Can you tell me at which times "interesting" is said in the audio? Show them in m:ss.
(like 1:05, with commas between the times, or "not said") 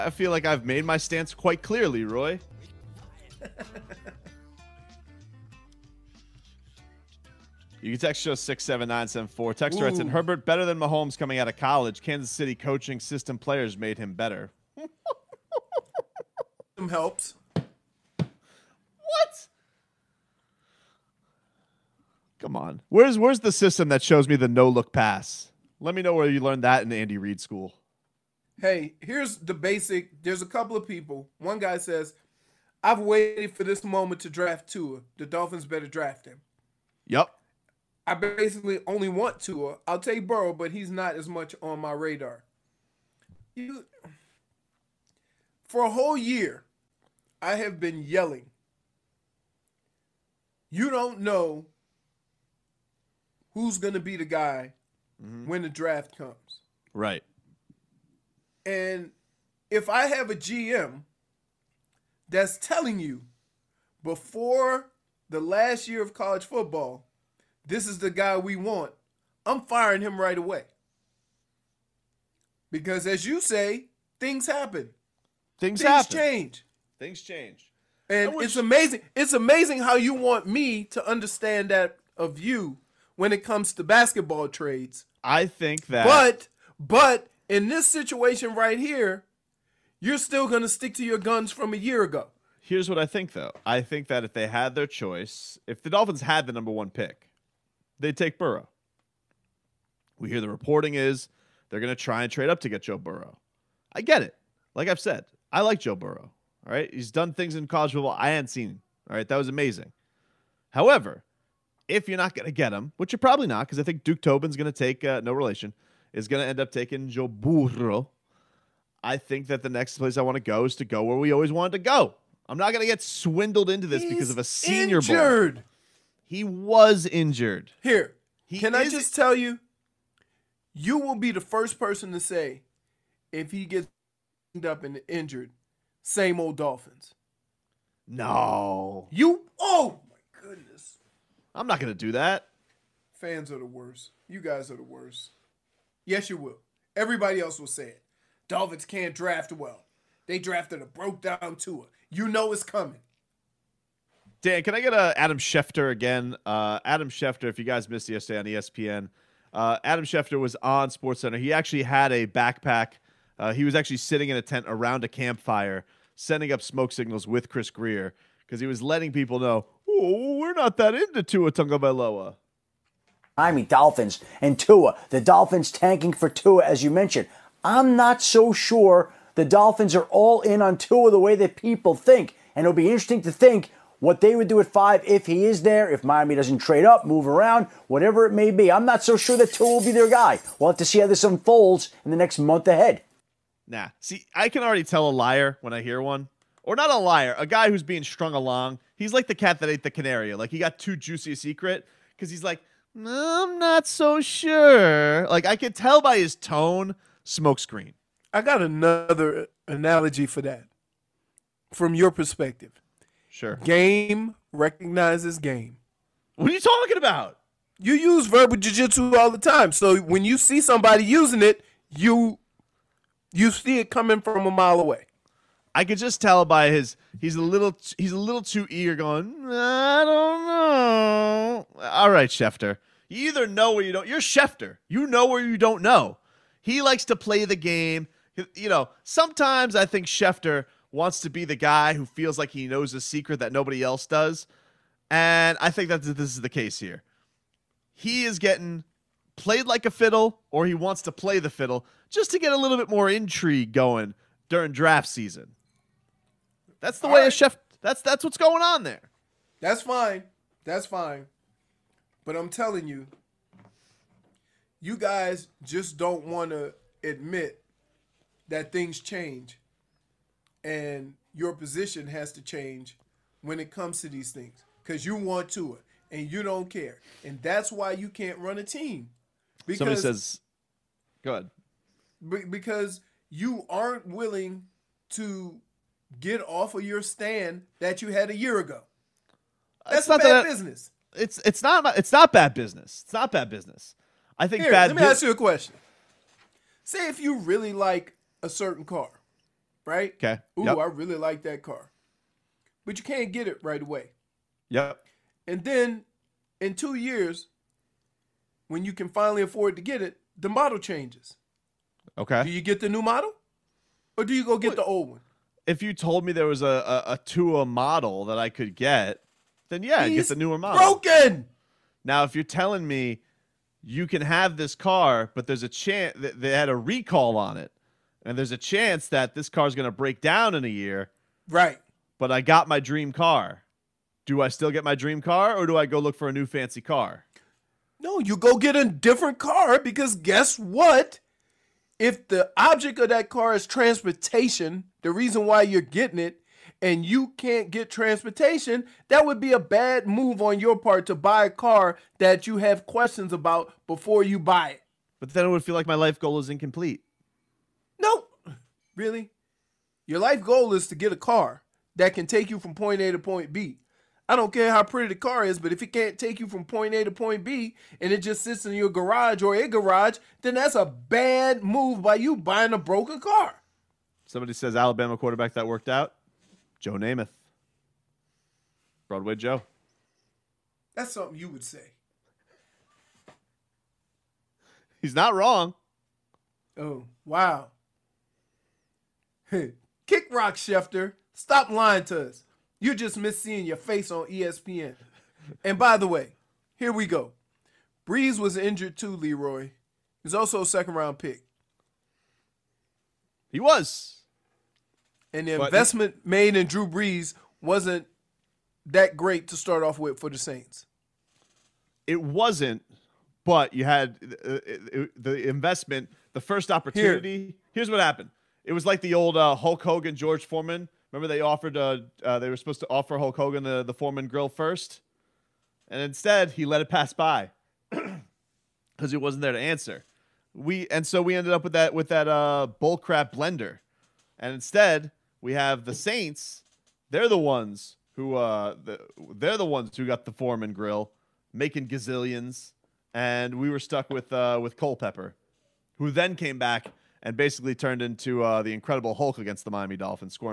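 3:02.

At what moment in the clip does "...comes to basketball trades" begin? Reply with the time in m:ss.
1:23.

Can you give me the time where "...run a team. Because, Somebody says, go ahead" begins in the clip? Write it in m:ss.
4:38.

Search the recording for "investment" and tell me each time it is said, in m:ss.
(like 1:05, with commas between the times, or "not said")
6:45, 6:55.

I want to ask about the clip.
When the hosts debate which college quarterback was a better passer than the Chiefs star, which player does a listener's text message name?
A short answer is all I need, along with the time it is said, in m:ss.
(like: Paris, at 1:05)
Herbert, at 0:10.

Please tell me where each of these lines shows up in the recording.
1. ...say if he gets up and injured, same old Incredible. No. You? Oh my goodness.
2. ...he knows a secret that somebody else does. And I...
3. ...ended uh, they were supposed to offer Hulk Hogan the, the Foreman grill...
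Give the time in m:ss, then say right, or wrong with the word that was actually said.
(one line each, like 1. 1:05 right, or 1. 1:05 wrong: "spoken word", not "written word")
1. 2:12 wrong: "Dolphins", not "Incredible"
2. 4:02 wrong: "nobody", not "somebody"
3. 7:01 wrong: "offered", not "ended".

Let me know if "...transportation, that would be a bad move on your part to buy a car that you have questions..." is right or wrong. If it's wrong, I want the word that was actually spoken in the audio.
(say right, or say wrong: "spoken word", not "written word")
right.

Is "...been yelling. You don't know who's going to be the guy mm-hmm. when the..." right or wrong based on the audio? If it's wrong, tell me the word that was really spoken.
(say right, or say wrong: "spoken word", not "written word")
right.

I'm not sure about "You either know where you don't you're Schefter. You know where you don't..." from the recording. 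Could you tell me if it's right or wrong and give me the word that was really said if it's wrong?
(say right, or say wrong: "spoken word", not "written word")
right.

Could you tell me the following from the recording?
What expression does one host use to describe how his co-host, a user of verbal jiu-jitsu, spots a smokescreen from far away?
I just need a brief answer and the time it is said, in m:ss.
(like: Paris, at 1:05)
Game recognizes game, at 3:33.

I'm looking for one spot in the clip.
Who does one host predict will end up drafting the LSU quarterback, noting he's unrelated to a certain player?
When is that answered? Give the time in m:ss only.
1:54.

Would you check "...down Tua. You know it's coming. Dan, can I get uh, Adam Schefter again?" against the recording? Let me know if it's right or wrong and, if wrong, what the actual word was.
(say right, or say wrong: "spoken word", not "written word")
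right.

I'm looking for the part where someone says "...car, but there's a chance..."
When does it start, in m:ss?
5:24.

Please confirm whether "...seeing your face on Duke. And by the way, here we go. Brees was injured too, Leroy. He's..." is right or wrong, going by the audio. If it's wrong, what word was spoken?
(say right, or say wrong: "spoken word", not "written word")
wrong: "ESPN", not "Duke".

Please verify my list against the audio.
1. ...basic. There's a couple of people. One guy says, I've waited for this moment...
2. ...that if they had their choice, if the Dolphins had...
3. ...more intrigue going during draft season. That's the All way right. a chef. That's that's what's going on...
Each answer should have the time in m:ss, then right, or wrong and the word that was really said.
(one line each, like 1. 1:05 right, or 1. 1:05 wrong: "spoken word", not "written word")
1. 0:29 right
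2. 1:34 right
3. 4:12 right.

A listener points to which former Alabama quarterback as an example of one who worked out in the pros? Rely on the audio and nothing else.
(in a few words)
Joe Namath.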